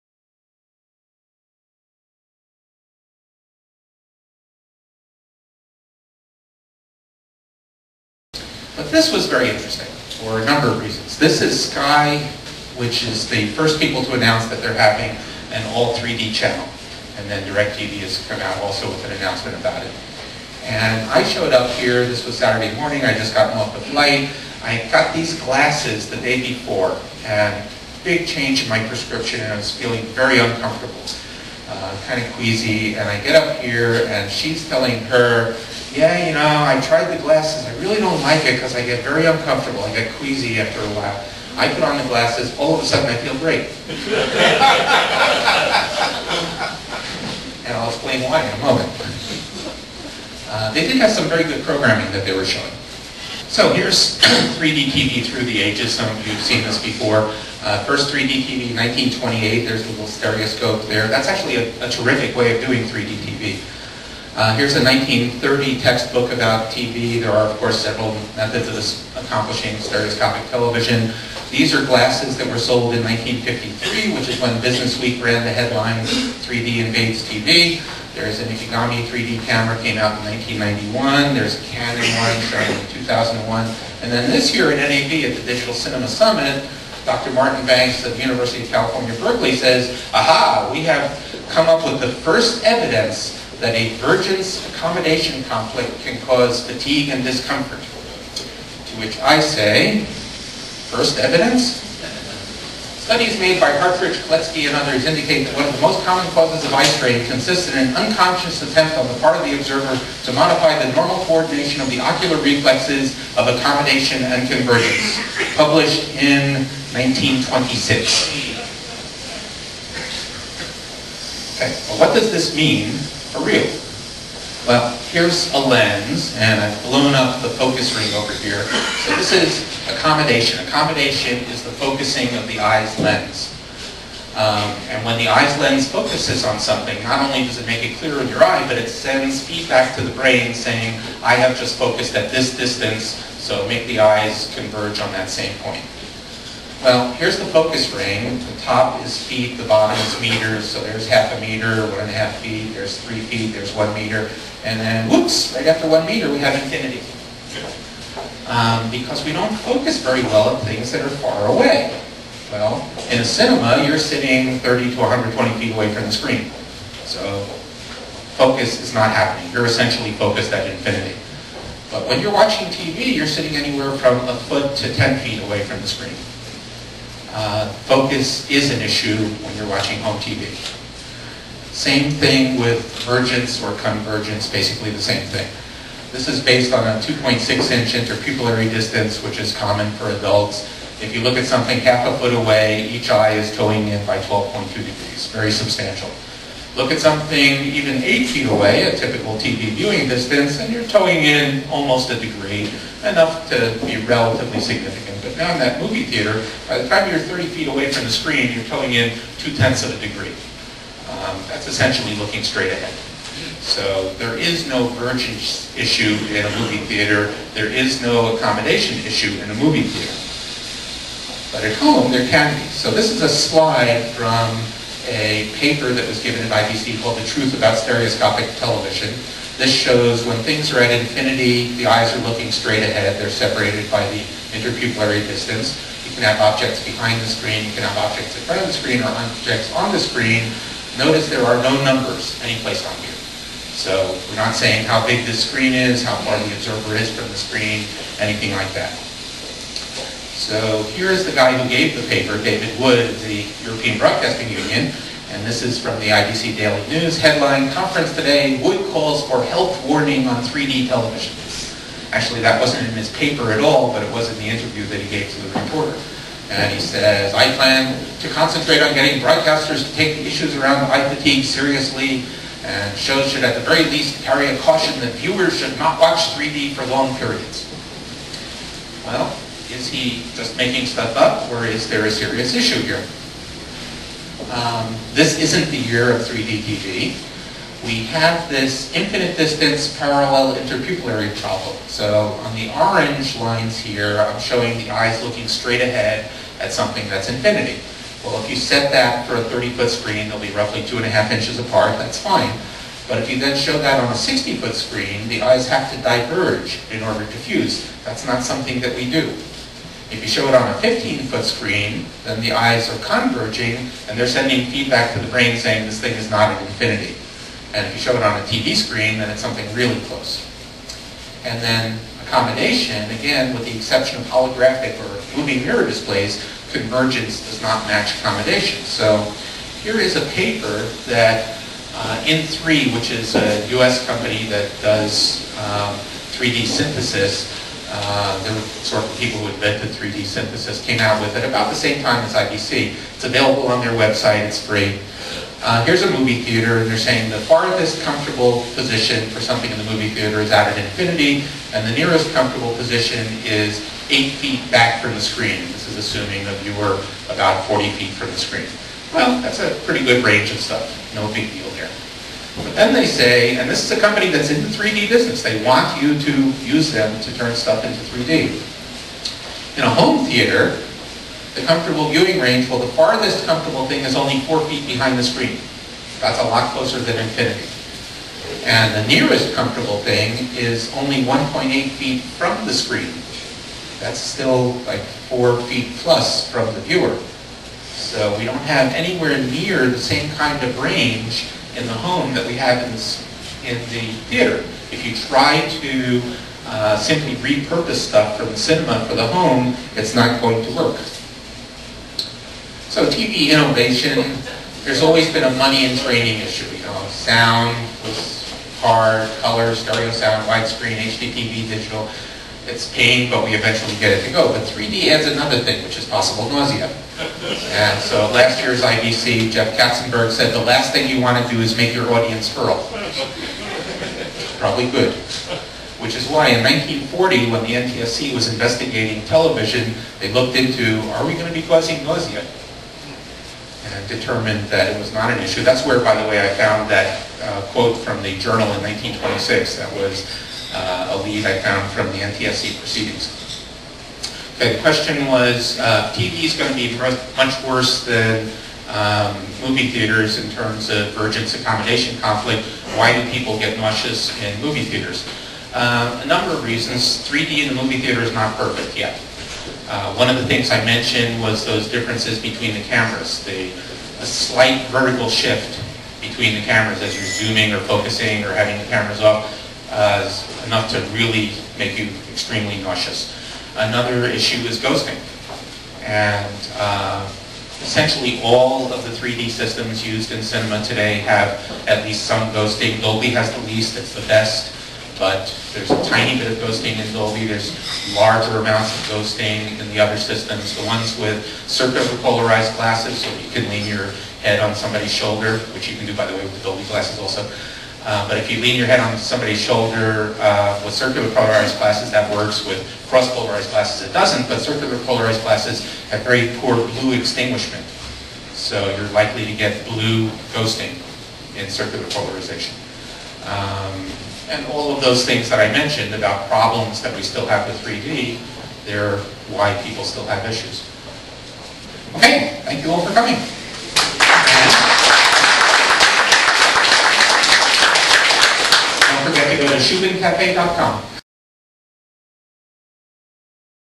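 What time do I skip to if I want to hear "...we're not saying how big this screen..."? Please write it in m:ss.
4:04.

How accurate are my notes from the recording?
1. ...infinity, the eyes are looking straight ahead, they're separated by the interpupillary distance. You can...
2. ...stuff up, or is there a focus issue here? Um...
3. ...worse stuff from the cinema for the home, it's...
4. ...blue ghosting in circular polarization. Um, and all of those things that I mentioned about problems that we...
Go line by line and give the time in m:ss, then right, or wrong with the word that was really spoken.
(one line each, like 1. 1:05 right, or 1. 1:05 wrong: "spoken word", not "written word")
1. 3:50 right
2. 4:40 wrong: "serious", not "focus"
3. 6:37 wrong: "repurpose", not "worse"
4. 8:29 right.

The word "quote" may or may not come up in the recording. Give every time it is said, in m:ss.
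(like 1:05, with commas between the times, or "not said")
7:17.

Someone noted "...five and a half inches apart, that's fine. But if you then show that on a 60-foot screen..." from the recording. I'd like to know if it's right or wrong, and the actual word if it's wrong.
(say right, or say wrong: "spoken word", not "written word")
wrong: "two", not "five".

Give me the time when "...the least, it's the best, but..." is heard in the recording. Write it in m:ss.
8:03.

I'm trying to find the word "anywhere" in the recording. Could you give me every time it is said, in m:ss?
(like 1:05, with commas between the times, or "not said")
2:53, 6:28.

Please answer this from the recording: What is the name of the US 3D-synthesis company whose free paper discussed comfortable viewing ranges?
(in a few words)
In-Three.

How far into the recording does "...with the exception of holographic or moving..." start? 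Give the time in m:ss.
5:23.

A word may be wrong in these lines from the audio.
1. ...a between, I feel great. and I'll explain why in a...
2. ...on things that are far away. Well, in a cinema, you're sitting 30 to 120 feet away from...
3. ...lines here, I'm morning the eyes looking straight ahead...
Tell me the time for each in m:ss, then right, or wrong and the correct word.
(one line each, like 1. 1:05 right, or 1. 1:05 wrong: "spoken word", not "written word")
1. 0:42 wrong: "sudden", not "between"
2. 2:40 right
3. 4:53 wrong: "showing", not "morning".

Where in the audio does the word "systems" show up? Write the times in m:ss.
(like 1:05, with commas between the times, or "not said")
7:59, 8:10.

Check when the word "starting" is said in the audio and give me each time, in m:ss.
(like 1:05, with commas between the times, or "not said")
1:22.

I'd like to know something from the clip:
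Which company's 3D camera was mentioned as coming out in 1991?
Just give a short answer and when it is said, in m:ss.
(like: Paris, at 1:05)
Ikegami, at 1:18.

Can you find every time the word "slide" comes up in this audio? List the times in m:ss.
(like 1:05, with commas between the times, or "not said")
3:43.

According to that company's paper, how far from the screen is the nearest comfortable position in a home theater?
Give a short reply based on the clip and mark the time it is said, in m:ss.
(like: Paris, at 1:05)
1.8 feet, at 6:21.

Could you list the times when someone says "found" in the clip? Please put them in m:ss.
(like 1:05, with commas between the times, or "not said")
7:16, 7:21.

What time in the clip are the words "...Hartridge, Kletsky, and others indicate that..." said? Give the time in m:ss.
1:43.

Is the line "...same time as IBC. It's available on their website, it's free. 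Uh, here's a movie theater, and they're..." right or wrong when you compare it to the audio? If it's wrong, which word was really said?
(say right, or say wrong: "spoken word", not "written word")
right.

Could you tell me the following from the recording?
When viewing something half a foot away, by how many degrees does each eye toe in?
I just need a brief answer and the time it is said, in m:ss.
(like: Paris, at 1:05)
12.2 degrees, at 3:14.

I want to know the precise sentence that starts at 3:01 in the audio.
Same thing with vergence or convergence, basically the same thing.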